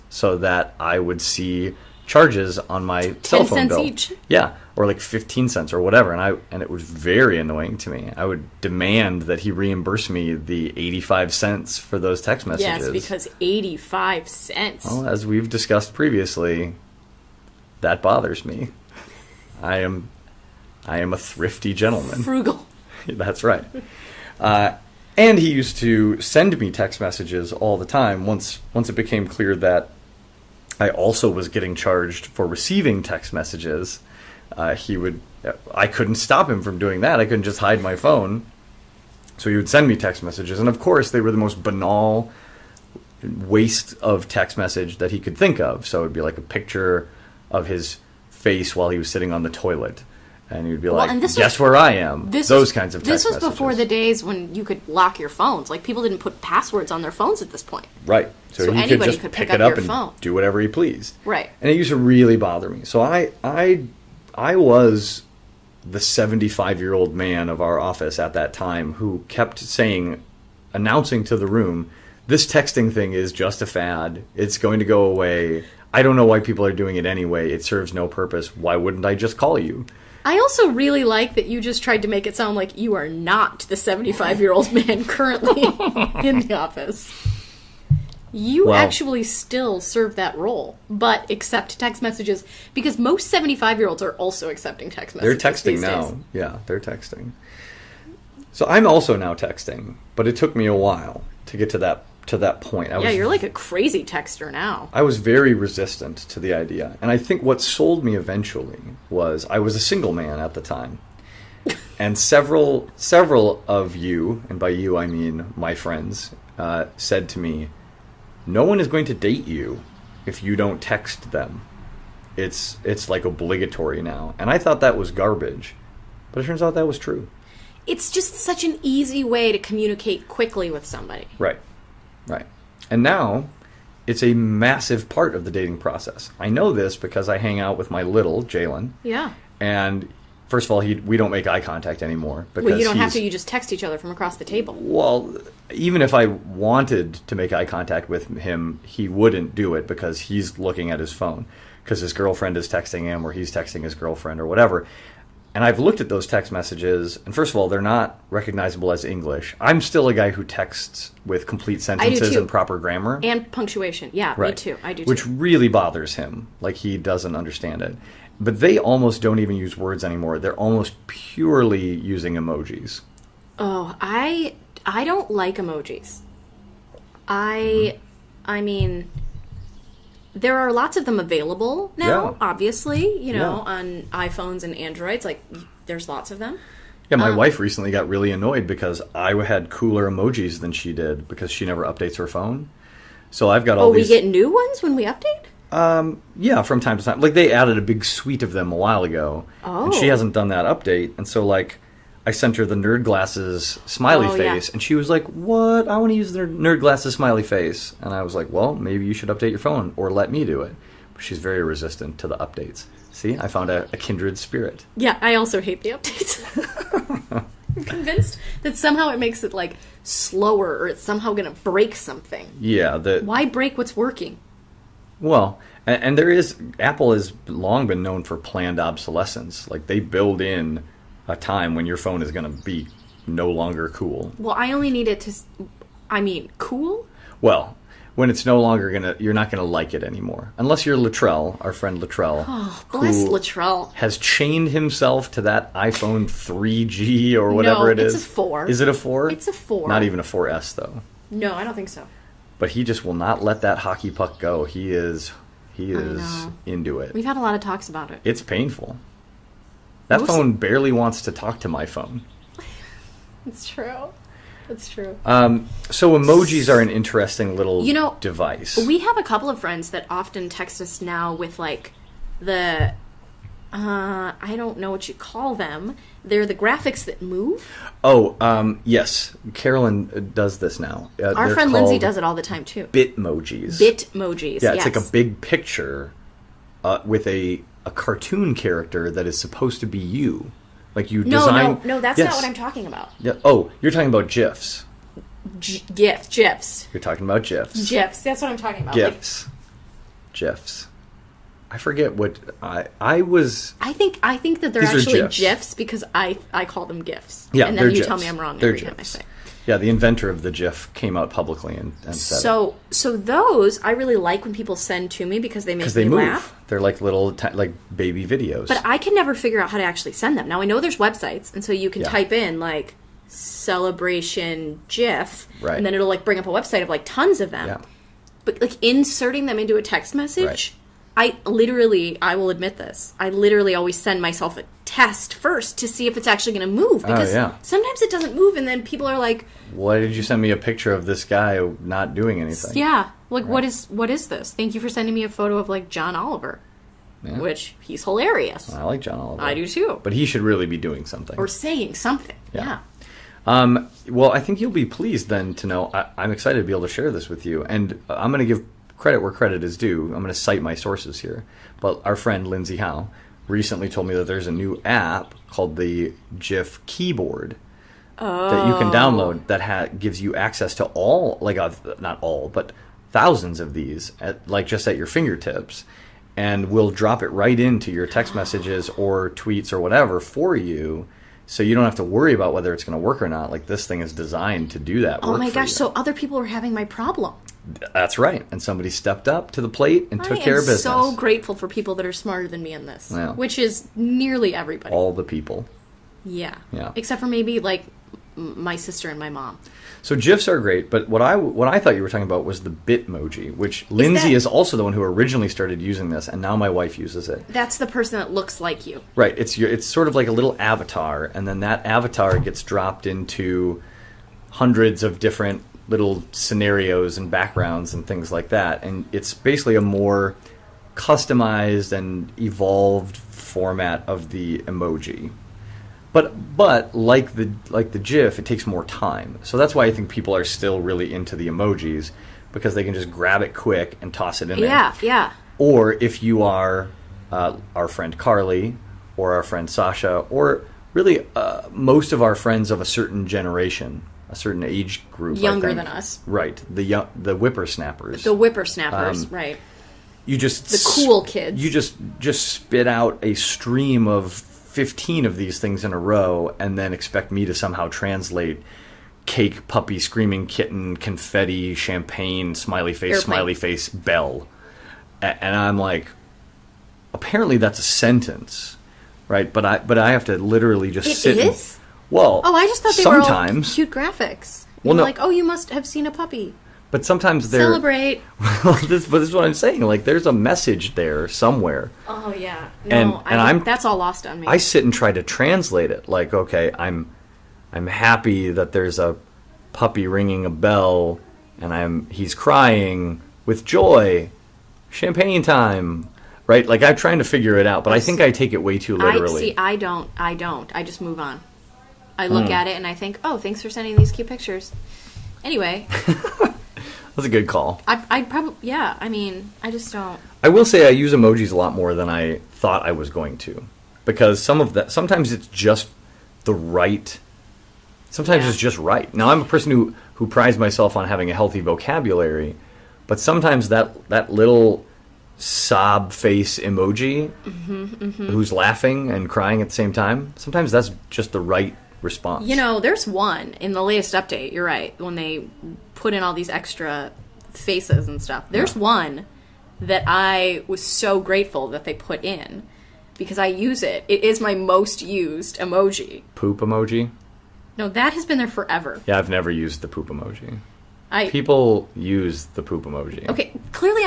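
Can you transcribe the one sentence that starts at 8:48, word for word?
who's laughing and crying at the same time, sometimes that's just the right response.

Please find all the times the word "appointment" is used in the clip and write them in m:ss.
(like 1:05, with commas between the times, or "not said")
not said.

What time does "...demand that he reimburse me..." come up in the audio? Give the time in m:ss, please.
0:08.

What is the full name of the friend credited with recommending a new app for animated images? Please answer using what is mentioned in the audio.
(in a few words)
Lindsay Howe.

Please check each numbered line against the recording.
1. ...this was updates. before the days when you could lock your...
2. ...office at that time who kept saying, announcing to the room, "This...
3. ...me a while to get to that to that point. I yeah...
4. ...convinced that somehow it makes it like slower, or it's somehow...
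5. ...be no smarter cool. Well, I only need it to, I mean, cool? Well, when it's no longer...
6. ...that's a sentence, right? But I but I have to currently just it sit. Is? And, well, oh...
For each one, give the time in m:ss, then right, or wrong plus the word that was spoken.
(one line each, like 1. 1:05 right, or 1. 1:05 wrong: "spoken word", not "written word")
1. 0:53 wrong: "messages", not "updates"
2. 1:07 right
3. 1:40 right
4. 3:37 right
5. 3:52 wrong: "longer", not "smarter"
6. 7:47 wrong: "literally", not "currently".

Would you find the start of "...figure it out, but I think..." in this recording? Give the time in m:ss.
8:17.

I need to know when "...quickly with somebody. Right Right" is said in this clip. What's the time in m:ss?
2:10.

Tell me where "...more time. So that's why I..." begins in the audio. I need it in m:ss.
7:08.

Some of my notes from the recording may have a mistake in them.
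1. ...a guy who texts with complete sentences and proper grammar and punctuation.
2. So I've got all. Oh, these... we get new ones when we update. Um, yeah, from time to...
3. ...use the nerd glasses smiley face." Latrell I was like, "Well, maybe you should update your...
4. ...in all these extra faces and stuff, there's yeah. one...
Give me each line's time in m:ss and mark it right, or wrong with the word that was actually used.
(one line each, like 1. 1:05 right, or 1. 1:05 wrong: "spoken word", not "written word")
1. 2:40 right
2. 3:13 right
3. 3:26 wrong: "And", not "Latrell"
4. 8:56 right.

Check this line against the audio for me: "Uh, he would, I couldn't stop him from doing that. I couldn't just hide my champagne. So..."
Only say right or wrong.
wrong.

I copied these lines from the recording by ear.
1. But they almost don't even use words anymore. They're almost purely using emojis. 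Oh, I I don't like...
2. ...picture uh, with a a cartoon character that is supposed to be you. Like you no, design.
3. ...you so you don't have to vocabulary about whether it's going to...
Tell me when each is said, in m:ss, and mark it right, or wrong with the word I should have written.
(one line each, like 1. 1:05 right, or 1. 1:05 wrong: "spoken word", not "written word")
1. 2:48 right
2. 4:45 right
3. 6:20 wrong: "worry", not "vocabulary".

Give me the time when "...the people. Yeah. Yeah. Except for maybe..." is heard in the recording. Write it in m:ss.
6:35.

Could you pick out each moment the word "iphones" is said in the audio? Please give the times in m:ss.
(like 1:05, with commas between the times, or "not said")
3:04, 4:05.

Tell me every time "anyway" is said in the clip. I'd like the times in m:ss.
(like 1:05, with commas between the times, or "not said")
1:17, 8:25.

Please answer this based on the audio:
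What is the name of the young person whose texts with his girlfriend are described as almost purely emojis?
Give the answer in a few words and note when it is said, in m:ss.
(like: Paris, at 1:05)
Jalen, at 2:18.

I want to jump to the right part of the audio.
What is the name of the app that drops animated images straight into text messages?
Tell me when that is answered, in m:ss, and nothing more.
6:06.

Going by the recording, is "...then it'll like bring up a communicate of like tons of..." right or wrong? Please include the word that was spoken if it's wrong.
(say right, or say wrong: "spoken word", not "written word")
wrong: "website", not "communicate".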